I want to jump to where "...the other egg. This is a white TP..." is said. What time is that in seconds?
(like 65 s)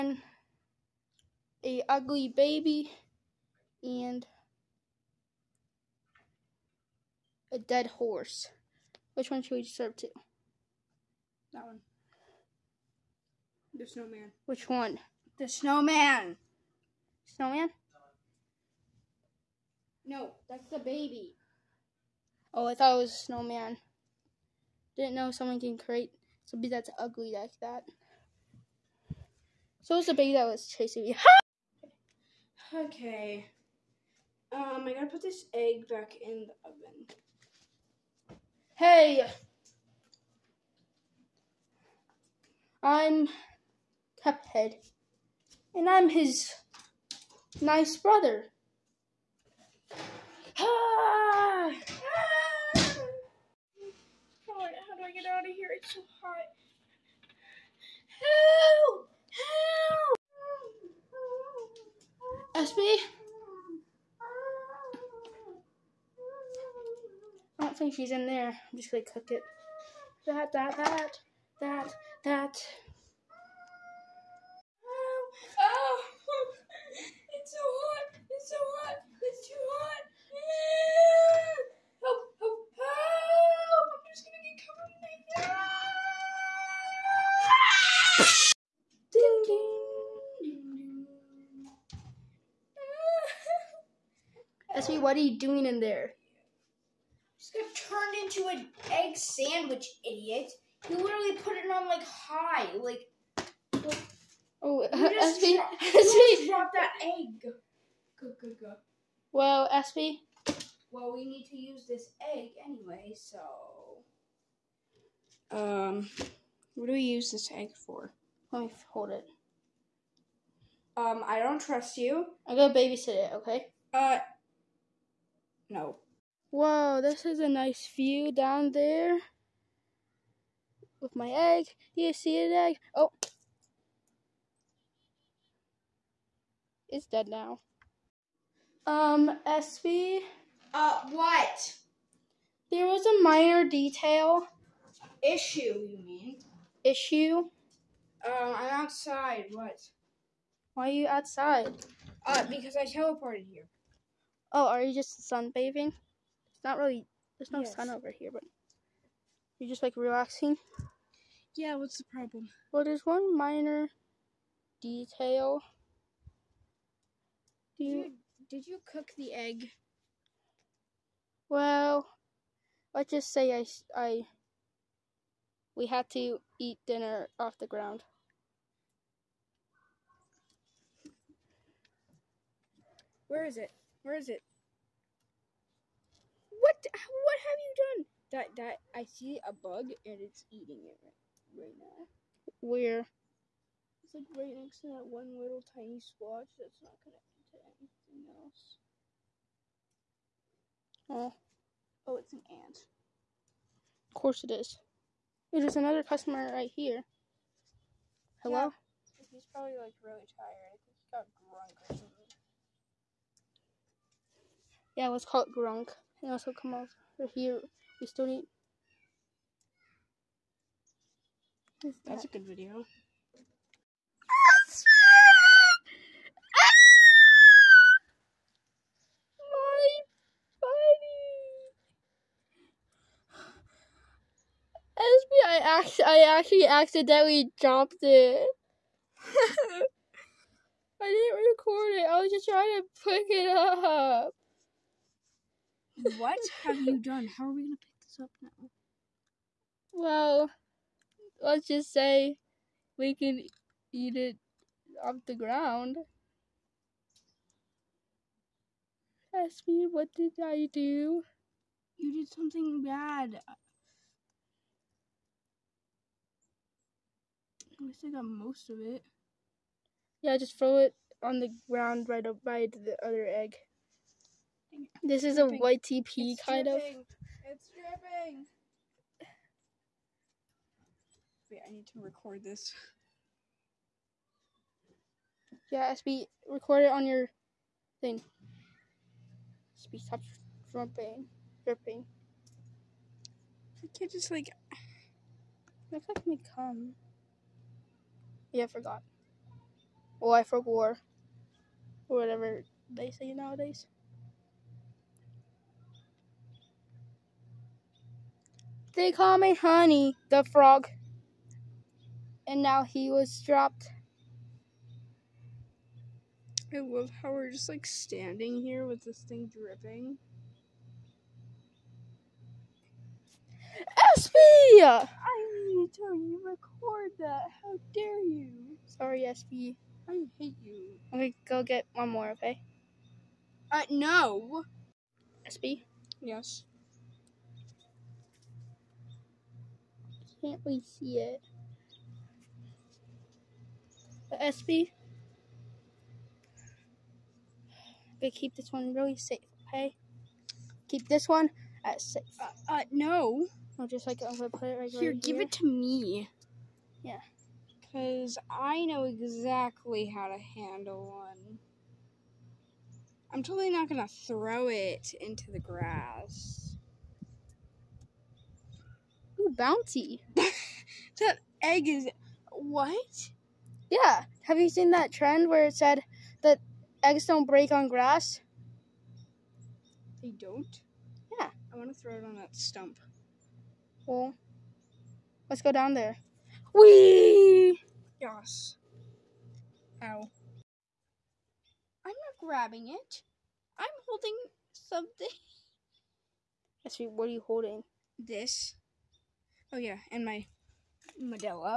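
272 s.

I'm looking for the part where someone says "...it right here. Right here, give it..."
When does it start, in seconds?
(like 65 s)
354 s.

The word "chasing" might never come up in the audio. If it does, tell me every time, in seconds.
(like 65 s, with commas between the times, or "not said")
30 s.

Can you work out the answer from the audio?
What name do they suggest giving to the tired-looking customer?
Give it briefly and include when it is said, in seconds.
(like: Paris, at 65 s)
Gronk, at 215 s.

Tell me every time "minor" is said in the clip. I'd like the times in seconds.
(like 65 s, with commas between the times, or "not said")
143 s, 163 s.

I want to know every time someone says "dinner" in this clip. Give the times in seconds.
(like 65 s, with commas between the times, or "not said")
176 s.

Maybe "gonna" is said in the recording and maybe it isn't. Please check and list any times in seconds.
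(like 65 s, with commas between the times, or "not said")
68 s, 122 s, 247 s, 363 s.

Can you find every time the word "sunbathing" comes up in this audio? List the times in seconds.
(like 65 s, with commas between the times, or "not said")
155 s.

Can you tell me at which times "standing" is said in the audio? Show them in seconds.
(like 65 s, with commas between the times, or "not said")
317 s.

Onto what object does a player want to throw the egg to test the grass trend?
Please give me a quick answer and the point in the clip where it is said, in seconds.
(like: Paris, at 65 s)
Stump, at 382 s.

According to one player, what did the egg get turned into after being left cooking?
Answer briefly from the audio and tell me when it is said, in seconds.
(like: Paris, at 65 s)
Egg sandwich, at 98 s.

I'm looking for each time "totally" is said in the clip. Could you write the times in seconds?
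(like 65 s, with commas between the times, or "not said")
363 s.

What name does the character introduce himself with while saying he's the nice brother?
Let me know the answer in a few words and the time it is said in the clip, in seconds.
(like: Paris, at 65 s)
Pephead, at 44 s.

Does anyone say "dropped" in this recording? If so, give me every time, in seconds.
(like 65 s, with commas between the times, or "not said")
106 s, 237 s, 313 s.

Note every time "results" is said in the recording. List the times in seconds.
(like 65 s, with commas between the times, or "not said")
not said.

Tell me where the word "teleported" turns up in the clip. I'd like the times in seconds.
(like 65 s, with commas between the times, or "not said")
152 s.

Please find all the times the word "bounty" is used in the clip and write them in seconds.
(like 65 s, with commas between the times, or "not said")
369 s.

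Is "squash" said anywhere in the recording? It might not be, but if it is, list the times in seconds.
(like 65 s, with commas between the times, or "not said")
196 s.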